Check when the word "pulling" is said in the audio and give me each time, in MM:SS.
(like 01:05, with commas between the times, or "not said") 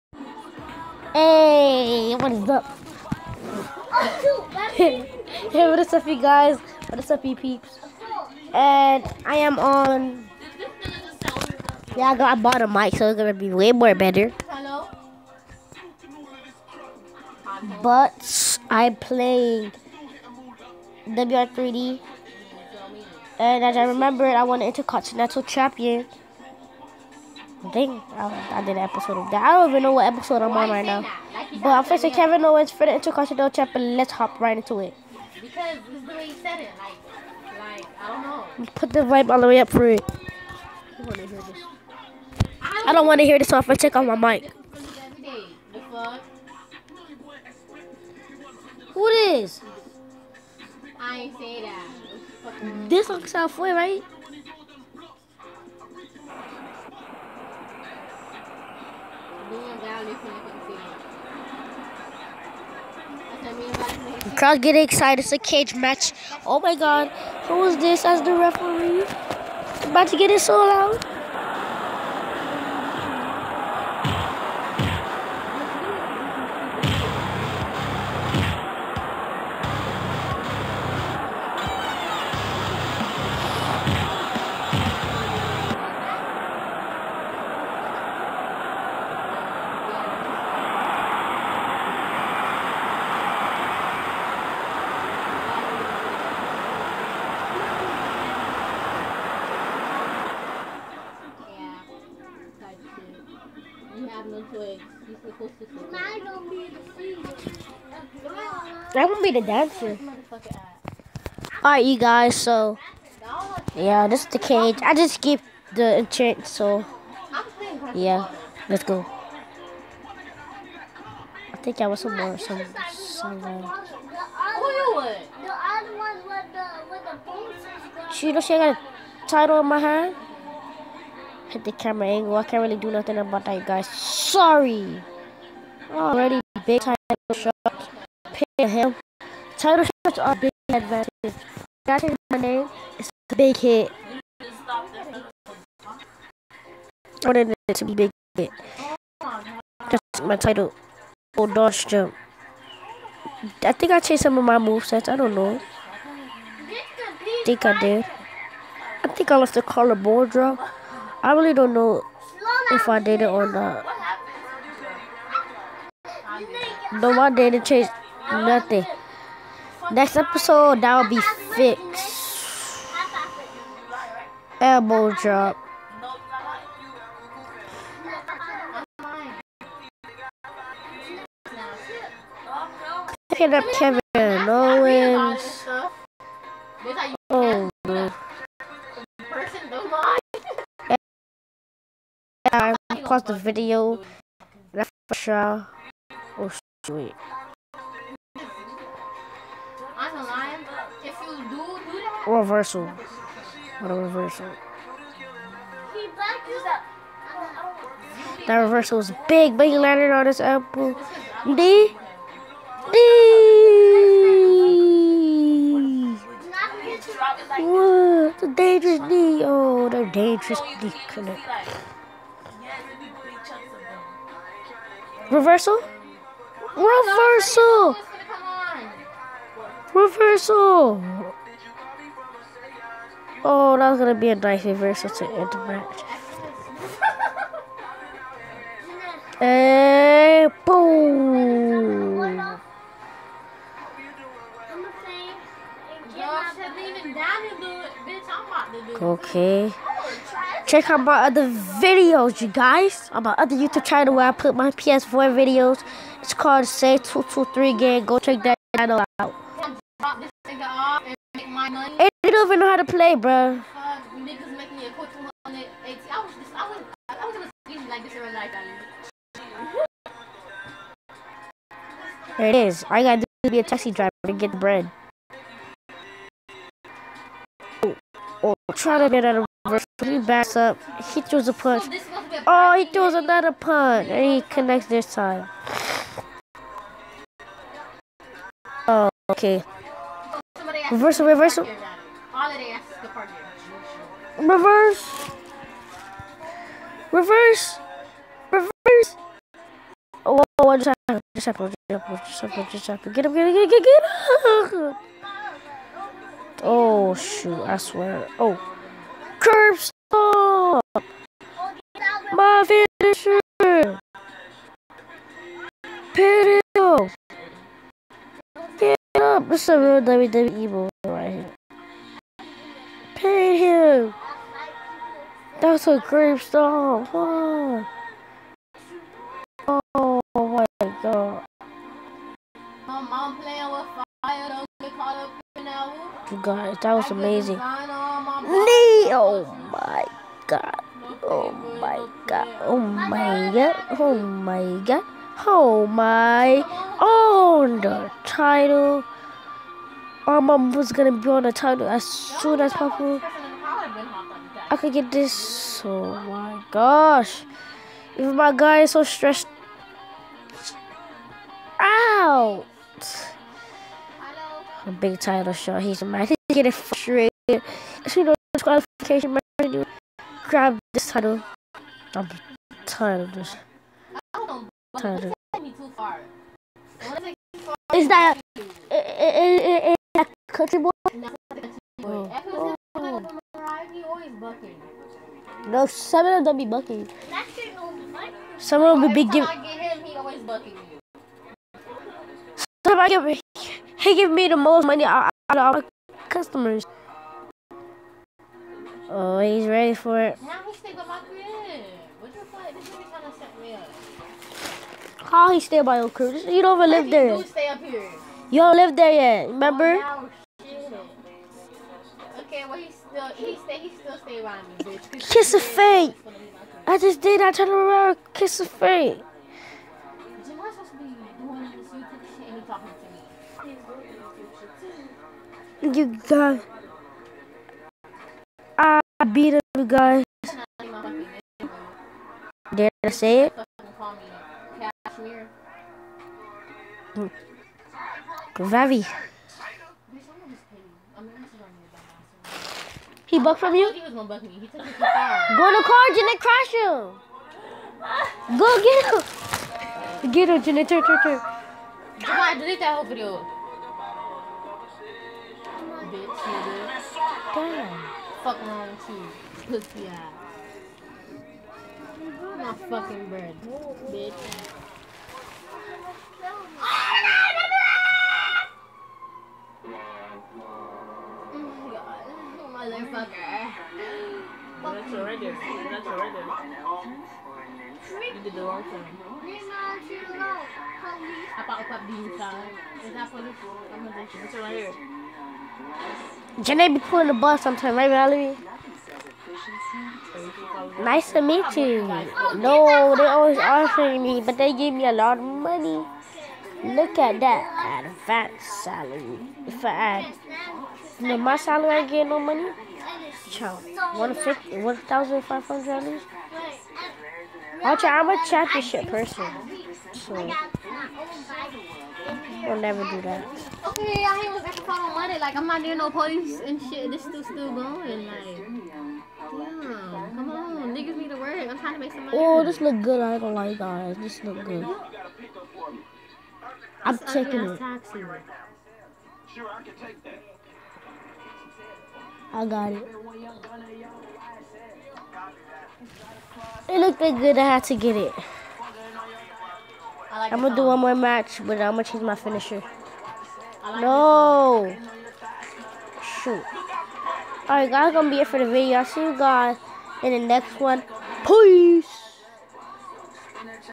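08:06.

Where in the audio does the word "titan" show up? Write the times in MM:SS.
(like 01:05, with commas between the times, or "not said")
not said.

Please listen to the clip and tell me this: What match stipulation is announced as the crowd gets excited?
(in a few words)
Cage match.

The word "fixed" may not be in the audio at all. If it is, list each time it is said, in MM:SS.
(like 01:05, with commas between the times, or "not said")
02:51.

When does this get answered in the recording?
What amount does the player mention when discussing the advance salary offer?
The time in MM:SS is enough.
08:24.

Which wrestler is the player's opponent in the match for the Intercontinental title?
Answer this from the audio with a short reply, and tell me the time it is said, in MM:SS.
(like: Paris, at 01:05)
Kevin Owens, at 00:32.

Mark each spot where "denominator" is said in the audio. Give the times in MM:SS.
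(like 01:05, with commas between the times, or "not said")
not said.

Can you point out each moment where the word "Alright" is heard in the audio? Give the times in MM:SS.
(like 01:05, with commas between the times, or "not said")
01:51, 09:07.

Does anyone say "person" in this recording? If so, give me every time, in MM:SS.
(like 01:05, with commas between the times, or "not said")
08:29.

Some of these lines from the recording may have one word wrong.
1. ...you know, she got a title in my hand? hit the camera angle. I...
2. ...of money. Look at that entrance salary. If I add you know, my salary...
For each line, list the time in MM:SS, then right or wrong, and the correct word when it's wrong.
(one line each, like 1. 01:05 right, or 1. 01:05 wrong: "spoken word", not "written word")
1. 02:08 right
2. 08:15 wrong: "advance", not "entrance".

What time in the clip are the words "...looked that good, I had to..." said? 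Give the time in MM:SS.
08:56.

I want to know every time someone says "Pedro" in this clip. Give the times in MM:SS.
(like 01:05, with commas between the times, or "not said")
05:16.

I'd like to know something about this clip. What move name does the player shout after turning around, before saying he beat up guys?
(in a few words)
Kiss of fate.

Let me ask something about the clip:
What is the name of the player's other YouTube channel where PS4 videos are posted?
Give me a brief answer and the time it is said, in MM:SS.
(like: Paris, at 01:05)
Say 223 Gang, at 04:16.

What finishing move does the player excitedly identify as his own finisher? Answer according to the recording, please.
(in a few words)
Curb Stomp.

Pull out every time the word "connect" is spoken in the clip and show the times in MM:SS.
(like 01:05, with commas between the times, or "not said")
03:41, 04:44.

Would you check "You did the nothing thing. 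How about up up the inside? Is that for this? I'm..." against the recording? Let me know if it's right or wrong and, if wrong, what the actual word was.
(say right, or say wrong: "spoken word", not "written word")
wrong: "wrong", not "nothing".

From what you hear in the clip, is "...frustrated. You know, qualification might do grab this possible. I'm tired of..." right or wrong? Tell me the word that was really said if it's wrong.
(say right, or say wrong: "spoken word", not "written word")
wrong: "title", not "possible".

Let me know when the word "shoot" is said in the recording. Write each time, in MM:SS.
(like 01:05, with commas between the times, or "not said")
05:07, 09:06.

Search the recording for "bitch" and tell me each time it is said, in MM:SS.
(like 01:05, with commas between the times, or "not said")
06:54, 07:36, 07:44.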